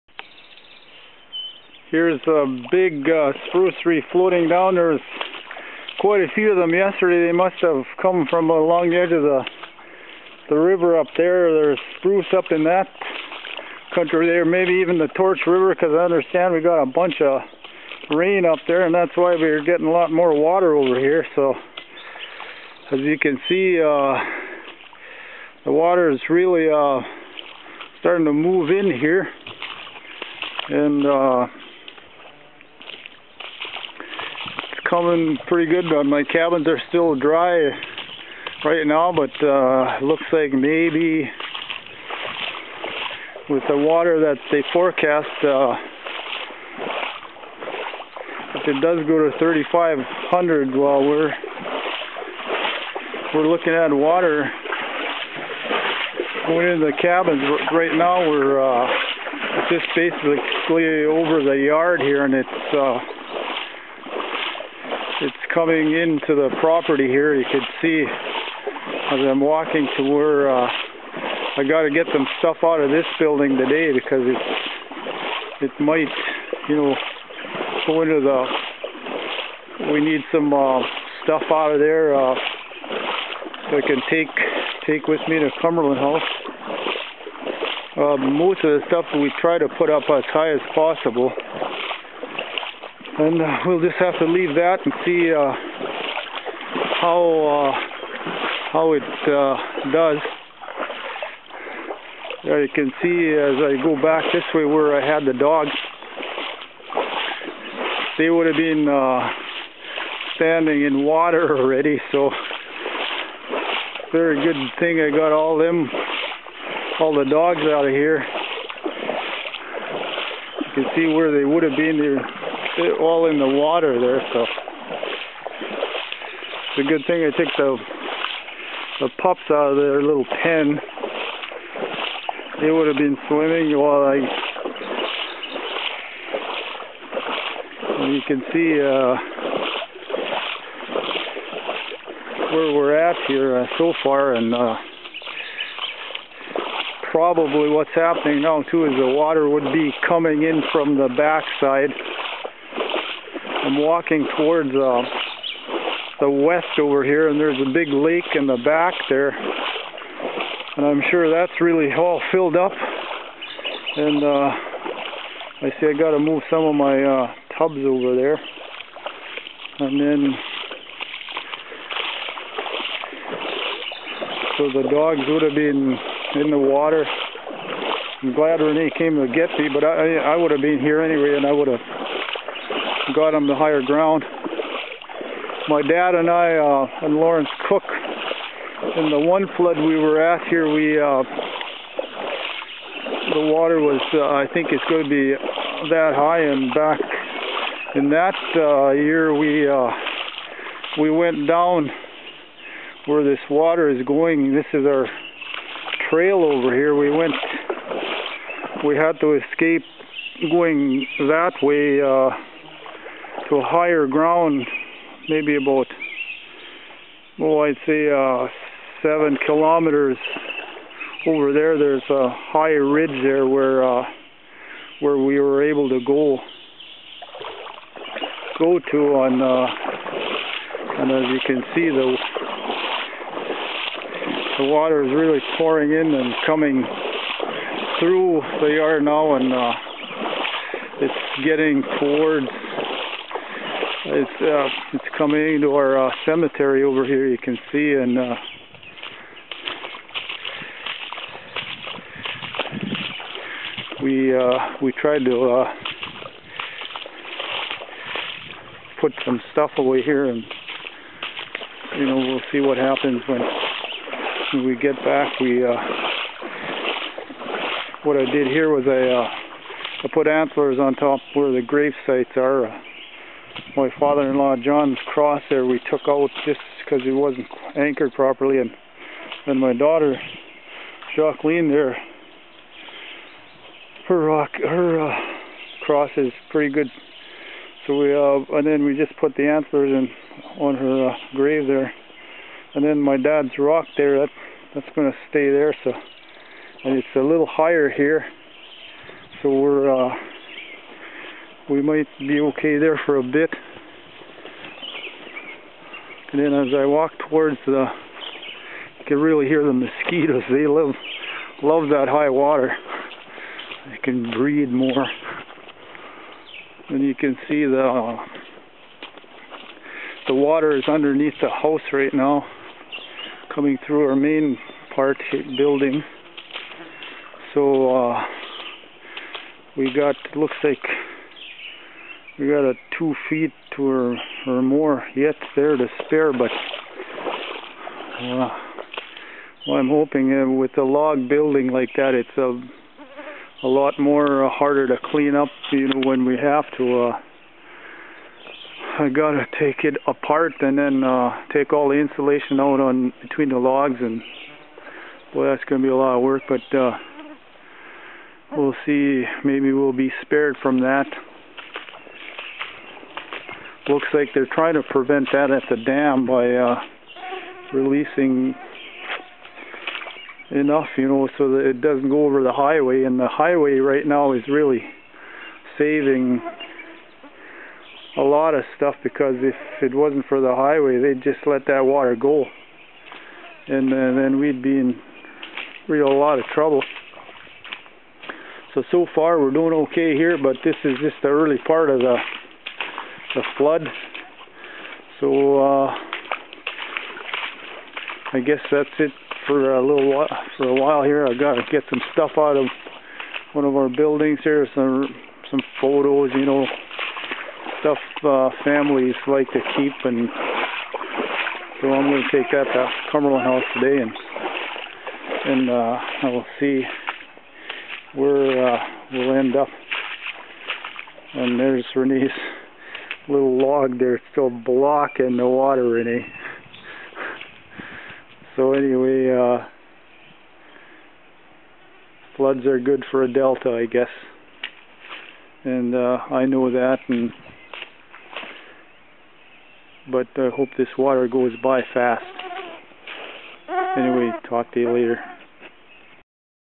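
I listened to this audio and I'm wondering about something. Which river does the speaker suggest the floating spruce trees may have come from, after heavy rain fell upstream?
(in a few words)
Torch River.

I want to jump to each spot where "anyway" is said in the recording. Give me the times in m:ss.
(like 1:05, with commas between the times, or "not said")
3:01, 7:08, 7:23.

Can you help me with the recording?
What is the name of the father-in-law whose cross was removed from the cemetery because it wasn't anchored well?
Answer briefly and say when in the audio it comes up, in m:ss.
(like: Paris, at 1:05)
John, at 4:34.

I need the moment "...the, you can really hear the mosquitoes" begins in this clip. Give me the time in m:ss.
5:07.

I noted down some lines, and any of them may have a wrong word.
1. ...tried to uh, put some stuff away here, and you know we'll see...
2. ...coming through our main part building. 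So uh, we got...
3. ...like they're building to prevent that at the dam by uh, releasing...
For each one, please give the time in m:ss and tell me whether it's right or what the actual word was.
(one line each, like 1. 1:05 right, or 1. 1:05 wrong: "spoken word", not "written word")
1. 4:14 right
2. 5:23 right
3. 6:04 wrong: "trying", not "building".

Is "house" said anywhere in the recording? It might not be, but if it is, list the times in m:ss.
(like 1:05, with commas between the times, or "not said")
1:25, 5:21, 6:53.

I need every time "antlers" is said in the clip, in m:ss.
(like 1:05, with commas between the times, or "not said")
4:30, 4:49.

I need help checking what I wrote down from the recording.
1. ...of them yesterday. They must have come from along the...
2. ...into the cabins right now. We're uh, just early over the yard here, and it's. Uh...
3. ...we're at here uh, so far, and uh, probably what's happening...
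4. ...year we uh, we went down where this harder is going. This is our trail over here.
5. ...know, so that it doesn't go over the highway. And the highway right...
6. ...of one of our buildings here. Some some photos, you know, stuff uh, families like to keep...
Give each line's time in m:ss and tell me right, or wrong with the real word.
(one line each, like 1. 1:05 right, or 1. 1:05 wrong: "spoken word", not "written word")
1. 0:06 right
2. 0:56 wrong: "basically", not "early"
3. 2:22 right
4. 3:18 wrong: "water", not "harder"
5. 6:11 right
6. 6:42 right.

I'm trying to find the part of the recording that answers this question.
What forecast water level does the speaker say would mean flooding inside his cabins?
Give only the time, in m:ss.
0:49.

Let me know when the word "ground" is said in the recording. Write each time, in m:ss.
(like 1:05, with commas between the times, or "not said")
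3:03, 3:34.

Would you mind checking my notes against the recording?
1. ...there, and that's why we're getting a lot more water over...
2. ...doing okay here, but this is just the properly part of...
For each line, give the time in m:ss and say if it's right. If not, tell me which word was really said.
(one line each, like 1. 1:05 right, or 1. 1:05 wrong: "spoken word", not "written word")
1. 0:18 right
2. 6:29 wrong: "early", not "properly".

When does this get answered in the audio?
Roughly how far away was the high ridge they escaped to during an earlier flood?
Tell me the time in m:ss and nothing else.
3:39.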